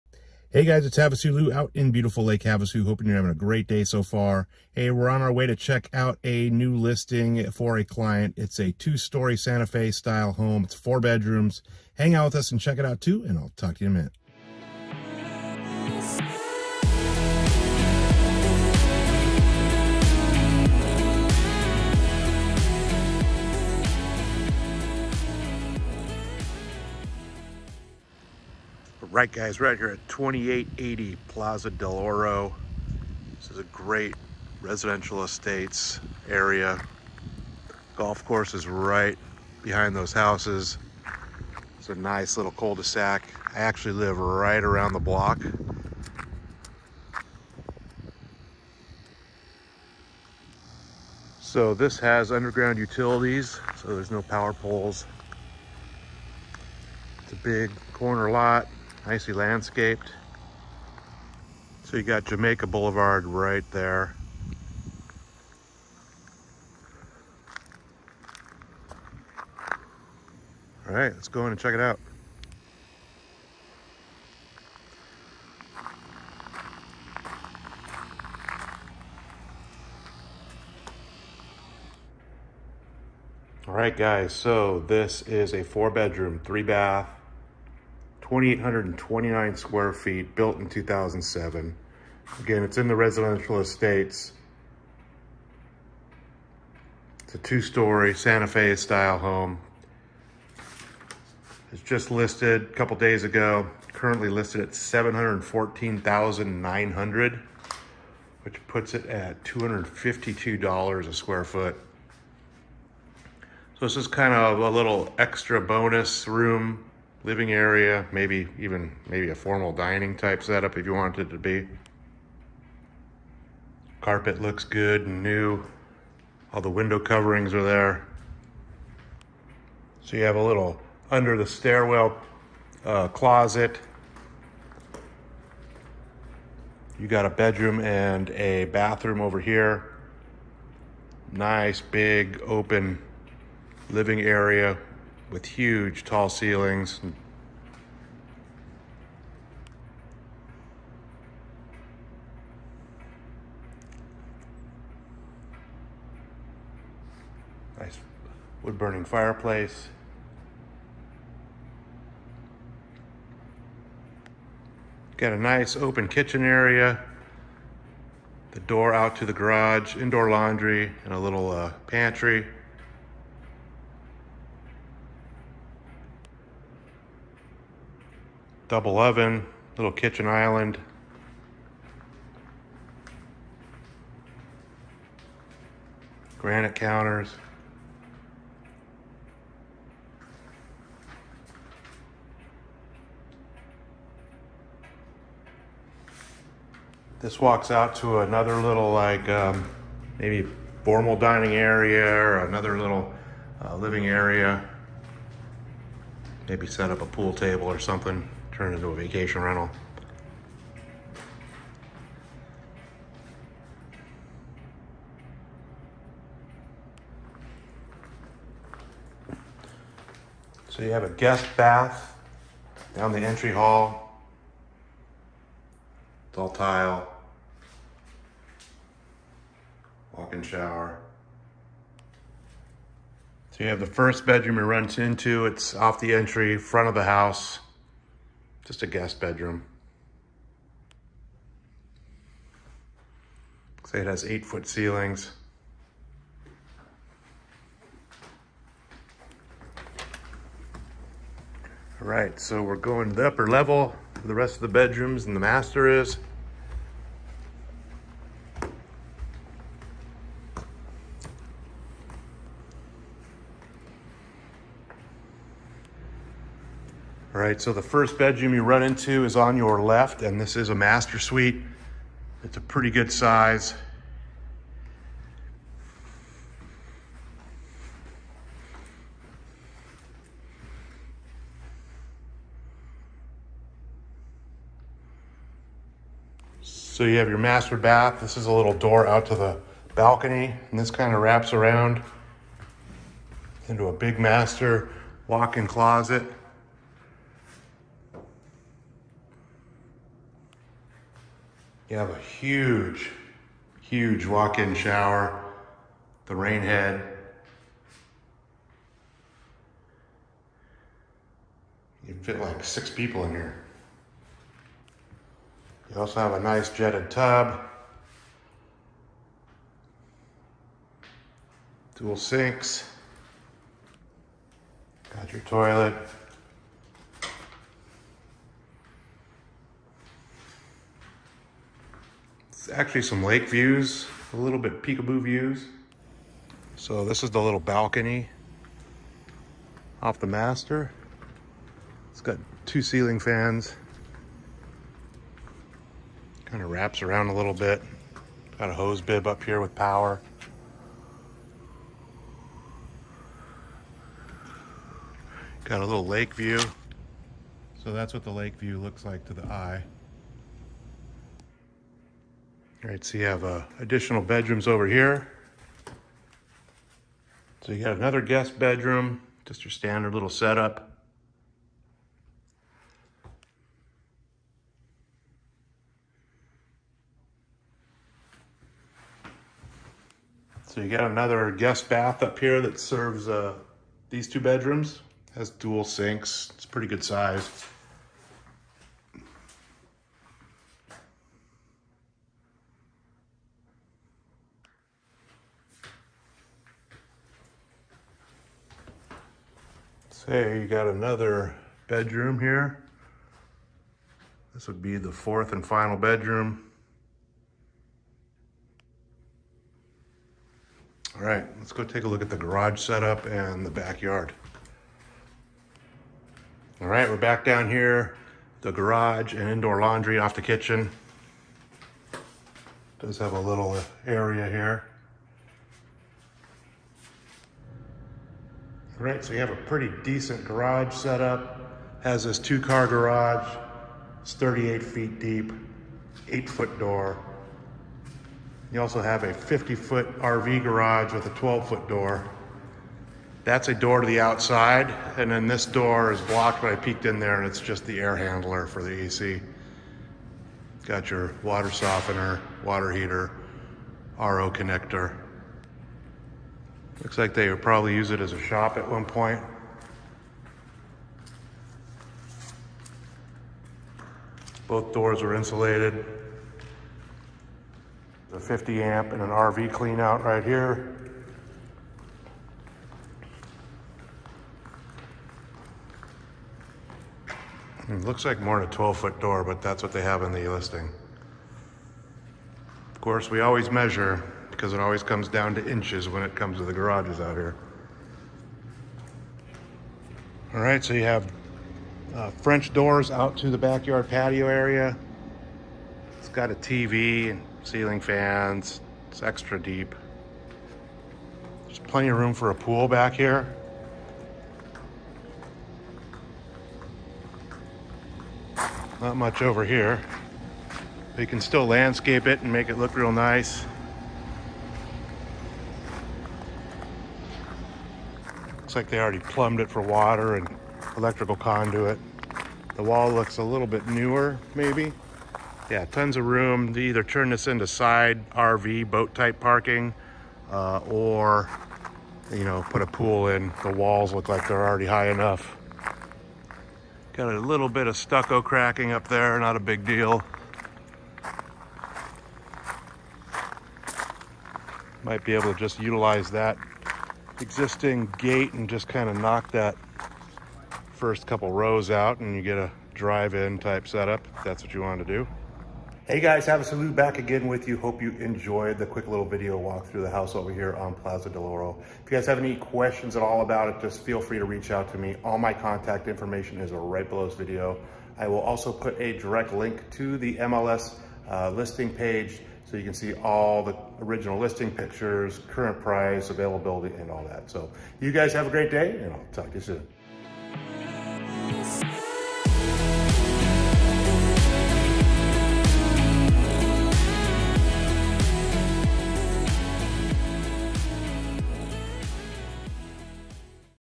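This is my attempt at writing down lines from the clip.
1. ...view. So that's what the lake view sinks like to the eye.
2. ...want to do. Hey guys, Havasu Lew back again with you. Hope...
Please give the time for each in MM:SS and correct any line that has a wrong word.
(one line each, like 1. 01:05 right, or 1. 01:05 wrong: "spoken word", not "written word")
1. 05:56 wrong: "looks", not "sinks"
2. 09:14 right.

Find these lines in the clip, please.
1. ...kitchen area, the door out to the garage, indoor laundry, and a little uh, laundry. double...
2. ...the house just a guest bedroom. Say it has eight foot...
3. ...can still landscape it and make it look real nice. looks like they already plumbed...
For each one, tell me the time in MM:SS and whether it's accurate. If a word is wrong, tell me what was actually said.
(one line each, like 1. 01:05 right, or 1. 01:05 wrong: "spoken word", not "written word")
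1. 02:46 wrong: "pantry", not "laundry"
2. 03:56 right
3. 08:31 right.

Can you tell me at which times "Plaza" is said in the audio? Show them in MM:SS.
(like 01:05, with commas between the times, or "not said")
00:31, 09:20.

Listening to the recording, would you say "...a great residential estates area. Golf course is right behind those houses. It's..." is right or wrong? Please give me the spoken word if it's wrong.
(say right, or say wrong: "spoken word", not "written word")
right.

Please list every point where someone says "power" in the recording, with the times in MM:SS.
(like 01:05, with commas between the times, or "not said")
00:54, 05:49.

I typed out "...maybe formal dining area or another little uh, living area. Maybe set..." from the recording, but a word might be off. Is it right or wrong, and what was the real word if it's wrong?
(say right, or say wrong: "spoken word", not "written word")
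right.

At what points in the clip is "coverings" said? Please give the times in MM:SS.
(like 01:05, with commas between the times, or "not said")
02:06.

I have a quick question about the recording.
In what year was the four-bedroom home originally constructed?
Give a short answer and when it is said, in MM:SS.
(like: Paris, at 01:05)
2007, at 01:30.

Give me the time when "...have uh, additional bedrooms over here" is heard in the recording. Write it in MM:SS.
06:03.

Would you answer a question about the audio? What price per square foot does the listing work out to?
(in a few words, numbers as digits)
$252.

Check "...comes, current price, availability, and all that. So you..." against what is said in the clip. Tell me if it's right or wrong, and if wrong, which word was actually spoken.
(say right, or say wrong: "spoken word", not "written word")
wrong: "pictures", not "comes".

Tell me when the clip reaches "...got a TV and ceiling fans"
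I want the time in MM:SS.
08:16.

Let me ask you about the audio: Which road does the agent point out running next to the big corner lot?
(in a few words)
Jamaica Boulevard.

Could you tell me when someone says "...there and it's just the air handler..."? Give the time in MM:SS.
07:27.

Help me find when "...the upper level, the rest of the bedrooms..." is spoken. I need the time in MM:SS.
04:13.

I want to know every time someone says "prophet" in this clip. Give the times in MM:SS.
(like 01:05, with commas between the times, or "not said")
not said.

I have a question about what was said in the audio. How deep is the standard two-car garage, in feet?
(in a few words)
38 feet.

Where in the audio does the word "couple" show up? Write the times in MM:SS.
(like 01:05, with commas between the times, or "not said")
01:42, 09:11.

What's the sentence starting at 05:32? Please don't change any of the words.
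actually some lake views, a little bit peekaboo views.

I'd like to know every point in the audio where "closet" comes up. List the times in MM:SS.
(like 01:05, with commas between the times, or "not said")
02:13, 04:55.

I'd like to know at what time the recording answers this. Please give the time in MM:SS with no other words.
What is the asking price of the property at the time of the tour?
01:44.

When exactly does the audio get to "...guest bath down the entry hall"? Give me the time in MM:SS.
03:41.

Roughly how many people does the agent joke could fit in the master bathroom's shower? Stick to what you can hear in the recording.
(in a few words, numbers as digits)
6.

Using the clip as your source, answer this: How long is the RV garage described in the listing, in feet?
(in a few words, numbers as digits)
50 feet.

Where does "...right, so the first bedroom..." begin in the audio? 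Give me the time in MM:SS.
04:27.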